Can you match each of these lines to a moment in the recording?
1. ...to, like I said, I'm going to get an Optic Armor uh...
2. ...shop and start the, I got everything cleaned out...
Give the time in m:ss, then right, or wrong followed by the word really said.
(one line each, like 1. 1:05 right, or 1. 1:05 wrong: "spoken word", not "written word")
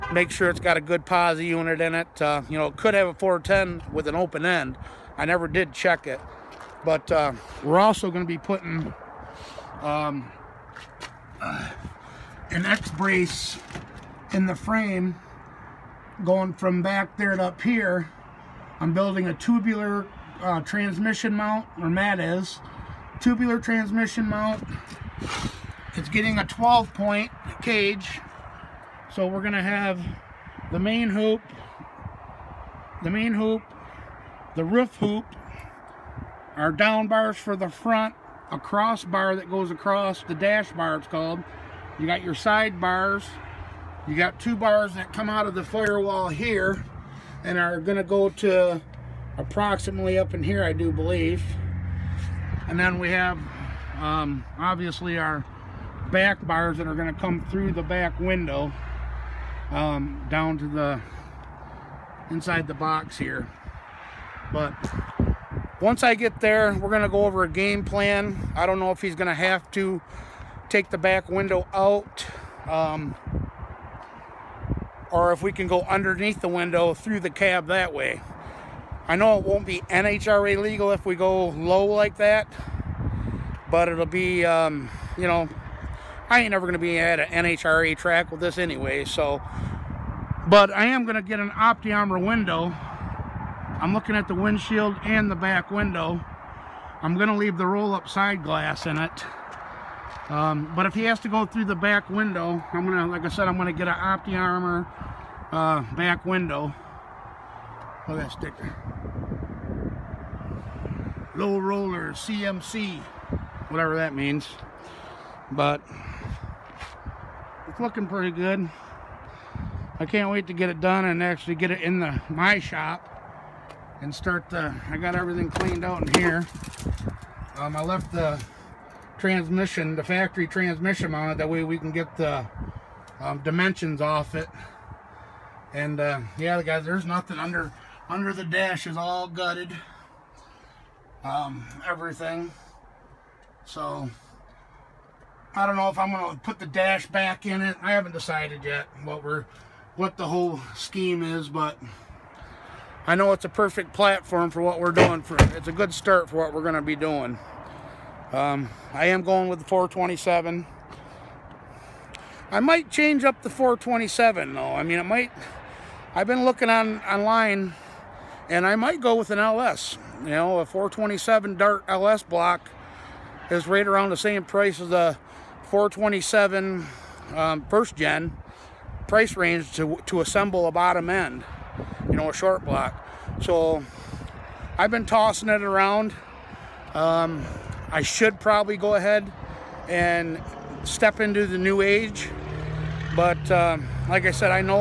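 1. 1:42 right
2. 2:02 right.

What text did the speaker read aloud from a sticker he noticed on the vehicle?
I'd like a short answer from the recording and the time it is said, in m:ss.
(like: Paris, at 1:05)
Low roller CMC, at 1:51.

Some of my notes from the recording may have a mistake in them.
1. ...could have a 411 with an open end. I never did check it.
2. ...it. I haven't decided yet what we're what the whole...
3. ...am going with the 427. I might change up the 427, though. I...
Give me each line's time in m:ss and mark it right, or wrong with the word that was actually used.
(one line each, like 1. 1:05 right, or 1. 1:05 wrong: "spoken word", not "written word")
1. 0:02 wrong: "410", not "411"
2. 2:27 right
3. 2:39 right.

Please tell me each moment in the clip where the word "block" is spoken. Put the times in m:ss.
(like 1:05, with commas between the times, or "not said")
2:52, 3:02.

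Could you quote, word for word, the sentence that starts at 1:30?
But I am going to get an Optic Armor window.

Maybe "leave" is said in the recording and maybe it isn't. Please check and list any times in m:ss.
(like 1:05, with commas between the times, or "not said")
1:37.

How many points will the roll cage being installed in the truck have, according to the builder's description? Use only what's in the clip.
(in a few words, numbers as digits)
12.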